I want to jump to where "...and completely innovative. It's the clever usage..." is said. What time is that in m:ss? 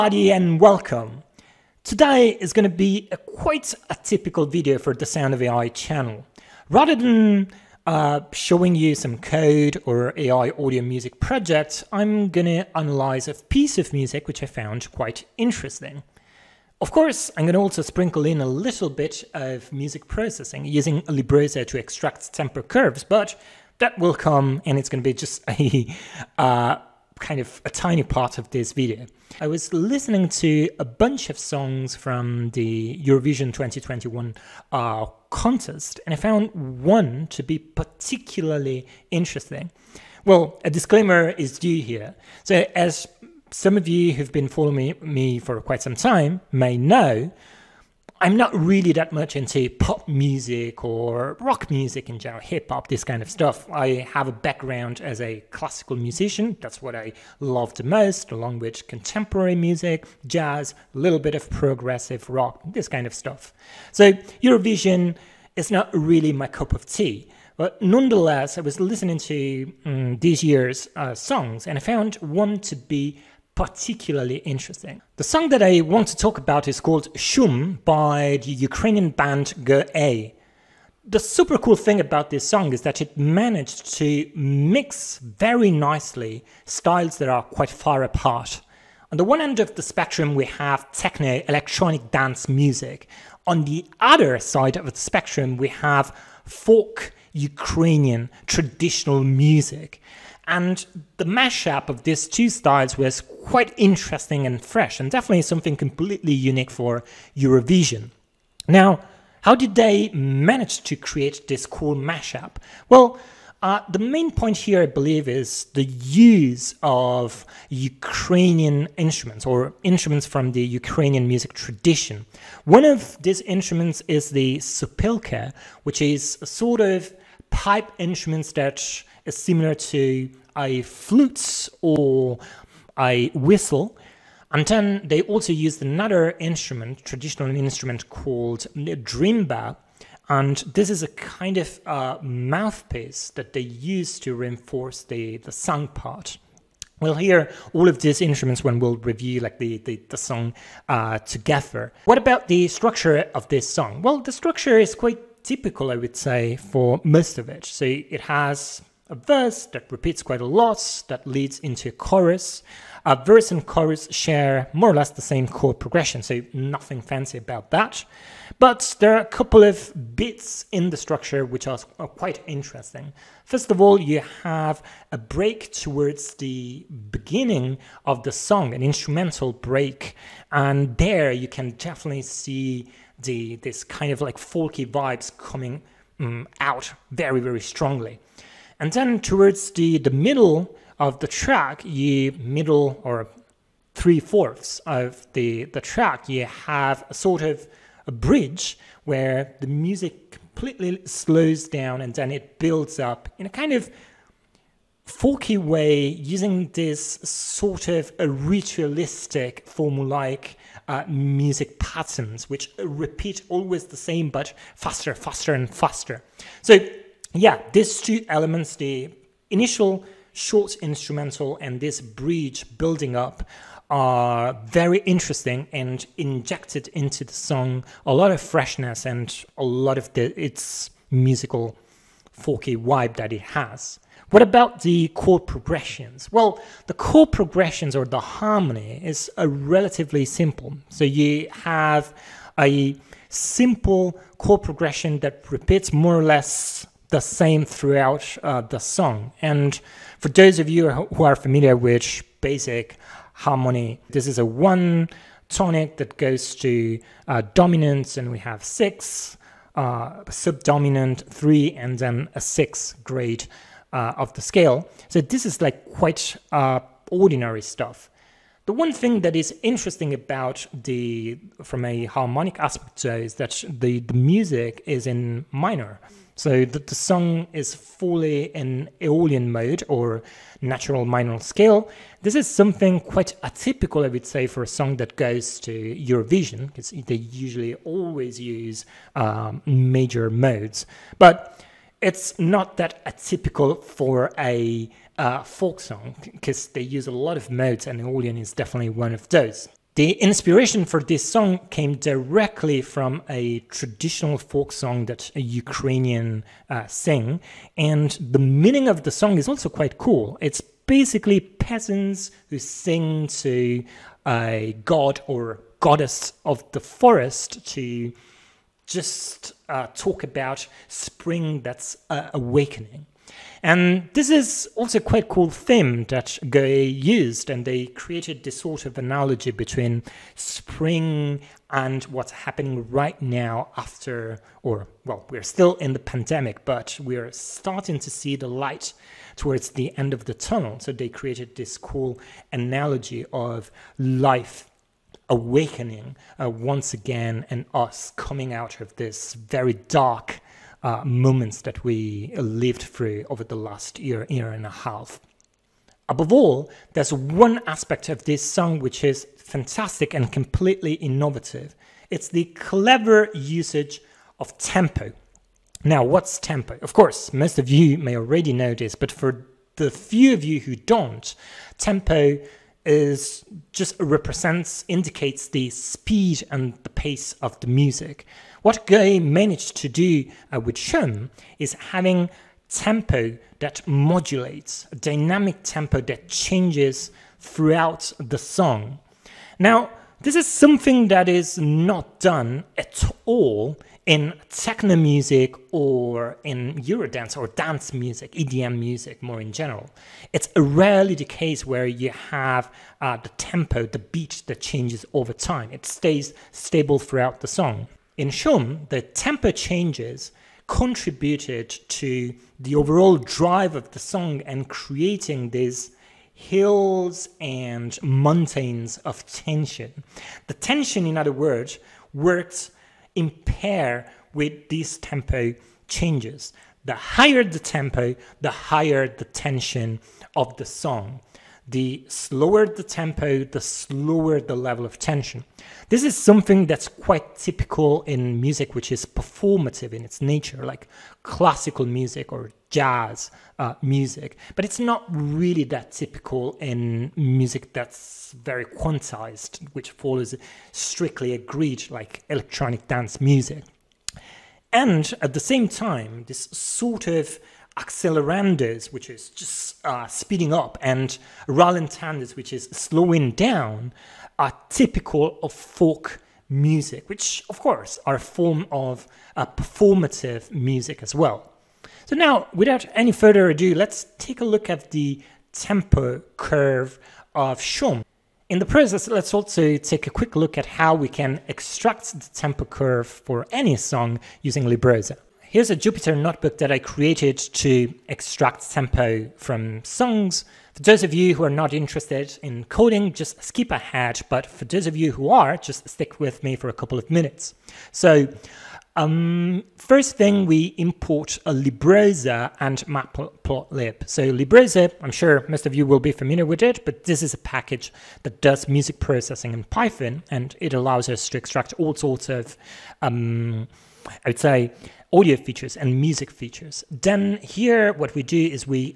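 6:00.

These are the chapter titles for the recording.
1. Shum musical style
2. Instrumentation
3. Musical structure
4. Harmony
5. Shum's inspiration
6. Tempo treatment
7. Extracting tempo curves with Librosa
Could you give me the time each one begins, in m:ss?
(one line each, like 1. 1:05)
1. 1:17
2. 1:49
3. 2:31
4. 3:34
5. 4:59
6. 5:56
7. 8:05.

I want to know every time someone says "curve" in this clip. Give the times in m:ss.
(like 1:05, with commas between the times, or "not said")
0:22, 7:56, 8:02.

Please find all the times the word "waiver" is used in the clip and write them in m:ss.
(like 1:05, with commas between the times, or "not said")
not said.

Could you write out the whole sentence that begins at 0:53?
I have a background as a classical musician.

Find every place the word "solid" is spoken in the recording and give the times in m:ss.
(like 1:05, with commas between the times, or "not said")
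not said.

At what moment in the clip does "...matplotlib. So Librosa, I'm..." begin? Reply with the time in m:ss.
8:22.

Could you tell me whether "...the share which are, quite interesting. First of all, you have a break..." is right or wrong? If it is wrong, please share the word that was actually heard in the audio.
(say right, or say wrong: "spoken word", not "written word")
wrong: "structure", not "share".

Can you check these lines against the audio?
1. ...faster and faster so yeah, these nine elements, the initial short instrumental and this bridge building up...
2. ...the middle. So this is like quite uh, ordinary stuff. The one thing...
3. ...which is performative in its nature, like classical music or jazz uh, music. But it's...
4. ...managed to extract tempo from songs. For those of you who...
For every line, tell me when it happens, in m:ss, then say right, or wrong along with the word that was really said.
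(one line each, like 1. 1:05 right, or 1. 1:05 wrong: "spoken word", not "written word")
1. 3:35 wrong: "two", not "nine"
2. 4:24 wrong: "scale", not "middle"
3. 7:18 right
4. 8:06 wrong: "created", not "managed".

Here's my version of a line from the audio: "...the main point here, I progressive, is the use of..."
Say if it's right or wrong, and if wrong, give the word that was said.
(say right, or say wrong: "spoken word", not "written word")
wrong: "believe", not "progressive".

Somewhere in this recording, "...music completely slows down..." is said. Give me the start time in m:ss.
3:19.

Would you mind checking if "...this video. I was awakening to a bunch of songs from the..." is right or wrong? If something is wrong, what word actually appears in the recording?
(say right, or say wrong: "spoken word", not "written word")
wrong: "listening", not "awakening".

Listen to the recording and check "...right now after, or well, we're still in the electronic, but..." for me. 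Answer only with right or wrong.
wrong.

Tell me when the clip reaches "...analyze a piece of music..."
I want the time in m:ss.
0:12.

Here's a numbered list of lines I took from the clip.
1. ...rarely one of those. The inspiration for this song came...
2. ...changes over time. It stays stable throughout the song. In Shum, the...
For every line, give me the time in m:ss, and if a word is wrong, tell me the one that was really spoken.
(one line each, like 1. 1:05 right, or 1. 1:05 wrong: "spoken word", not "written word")
1. 4:58 wrong: "definitely", not "rarely"
2. 6:44 right.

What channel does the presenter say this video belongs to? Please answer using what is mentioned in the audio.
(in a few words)
The Sound of AI.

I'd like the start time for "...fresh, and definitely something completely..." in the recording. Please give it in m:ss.
1:44.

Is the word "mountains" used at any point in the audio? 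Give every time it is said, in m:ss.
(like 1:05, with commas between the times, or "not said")
6:58.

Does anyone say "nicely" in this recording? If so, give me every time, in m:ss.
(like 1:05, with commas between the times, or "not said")
1:25.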